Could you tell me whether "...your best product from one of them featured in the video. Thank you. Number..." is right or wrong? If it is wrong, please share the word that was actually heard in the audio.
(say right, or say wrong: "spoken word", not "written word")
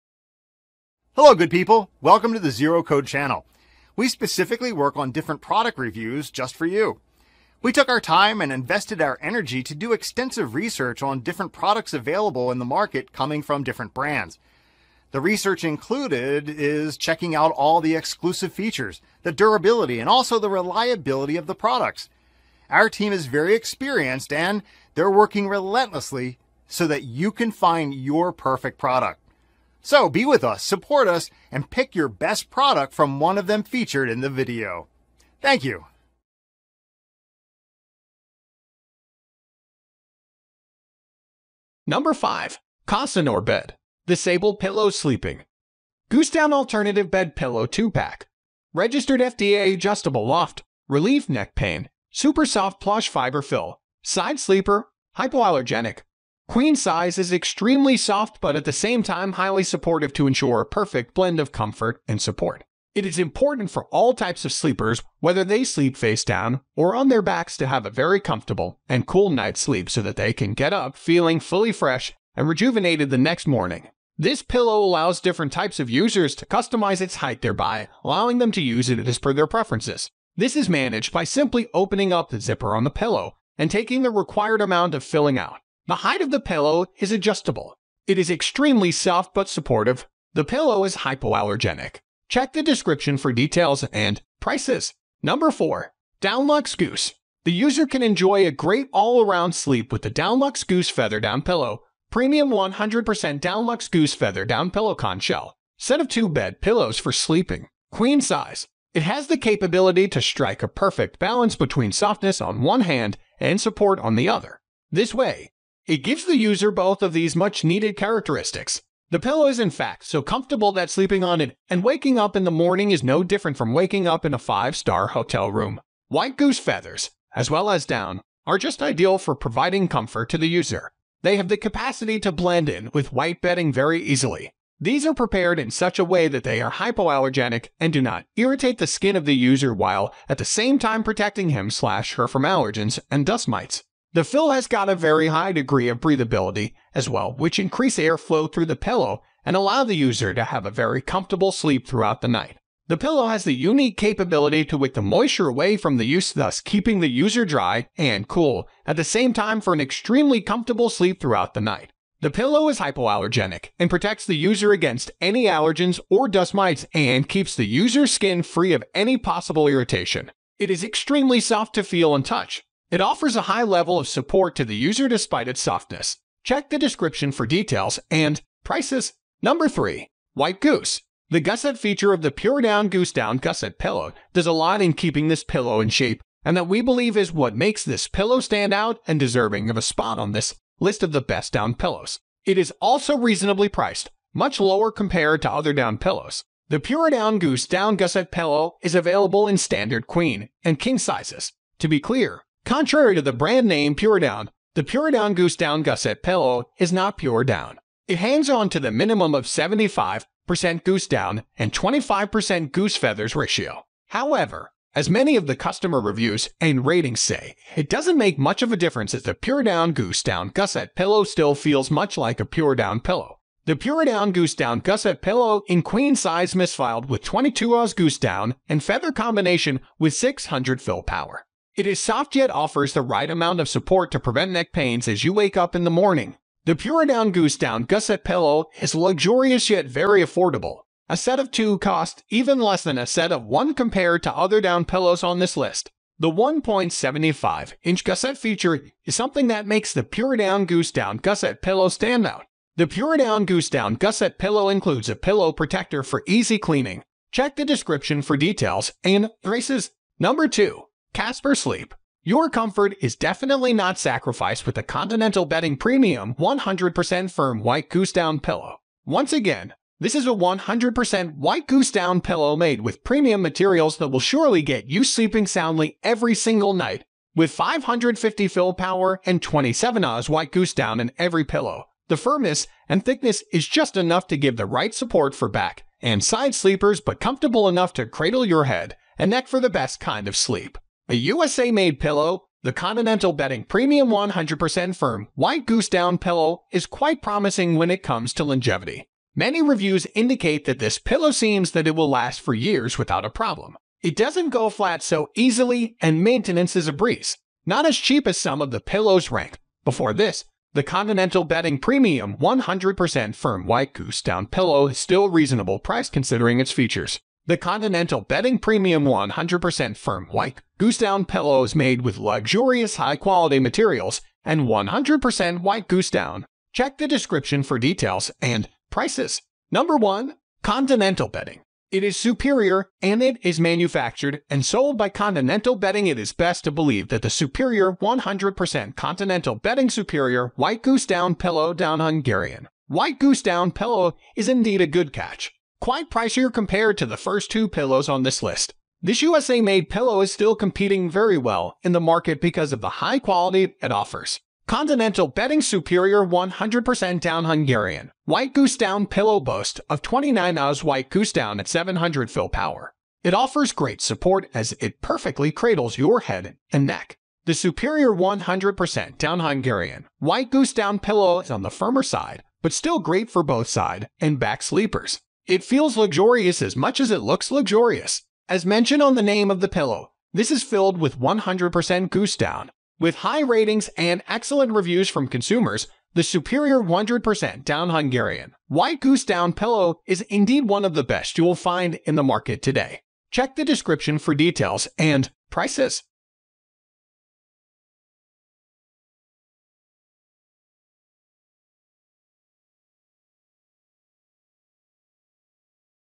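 right.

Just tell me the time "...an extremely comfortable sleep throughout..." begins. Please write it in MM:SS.
02:39.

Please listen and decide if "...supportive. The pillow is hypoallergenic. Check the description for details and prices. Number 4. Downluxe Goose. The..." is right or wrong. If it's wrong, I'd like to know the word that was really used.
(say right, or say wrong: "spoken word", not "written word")
right.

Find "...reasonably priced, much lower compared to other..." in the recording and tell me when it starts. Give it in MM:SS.
03:13.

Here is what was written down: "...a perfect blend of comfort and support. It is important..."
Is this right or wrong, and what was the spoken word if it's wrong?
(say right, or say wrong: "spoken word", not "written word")
right.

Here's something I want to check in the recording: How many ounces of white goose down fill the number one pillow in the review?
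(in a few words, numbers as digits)
29 oz.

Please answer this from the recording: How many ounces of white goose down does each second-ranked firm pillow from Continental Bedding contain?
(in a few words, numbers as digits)
27 oz.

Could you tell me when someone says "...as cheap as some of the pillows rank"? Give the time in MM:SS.
05:07.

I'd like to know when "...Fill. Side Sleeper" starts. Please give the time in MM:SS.
00:53.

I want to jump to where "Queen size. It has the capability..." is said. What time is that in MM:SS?
01:47.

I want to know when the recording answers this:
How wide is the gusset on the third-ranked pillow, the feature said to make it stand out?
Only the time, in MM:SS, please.
04:06.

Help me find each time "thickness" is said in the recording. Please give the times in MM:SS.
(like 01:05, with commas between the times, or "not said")
04:43.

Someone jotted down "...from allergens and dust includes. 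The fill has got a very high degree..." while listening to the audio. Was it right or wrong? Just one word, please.
wrong.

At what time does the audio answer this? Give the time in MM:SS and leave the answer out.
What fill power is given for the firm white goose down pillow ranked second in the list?
04:37.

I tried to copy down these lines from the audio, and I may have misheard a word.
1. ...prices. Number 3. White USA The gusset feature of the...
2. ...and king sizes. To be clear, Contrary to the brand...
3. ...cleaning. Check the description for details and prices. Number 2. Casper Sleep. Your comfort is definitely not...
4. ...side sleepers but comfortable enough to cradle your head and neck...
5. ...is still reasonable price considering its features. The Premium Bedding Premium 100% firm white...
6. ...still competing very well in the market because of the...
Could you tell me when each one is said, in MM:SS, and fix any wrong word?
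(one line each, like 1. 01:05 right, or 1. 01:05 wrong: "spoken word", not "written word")
1. 02:58 wrong: "Goose", not "USA"
2. 03:20 right
3. 04:16 right
4. 04:46 right
5. 05:14 wrong: "Continental", not "Premium"
6. 05:50 right.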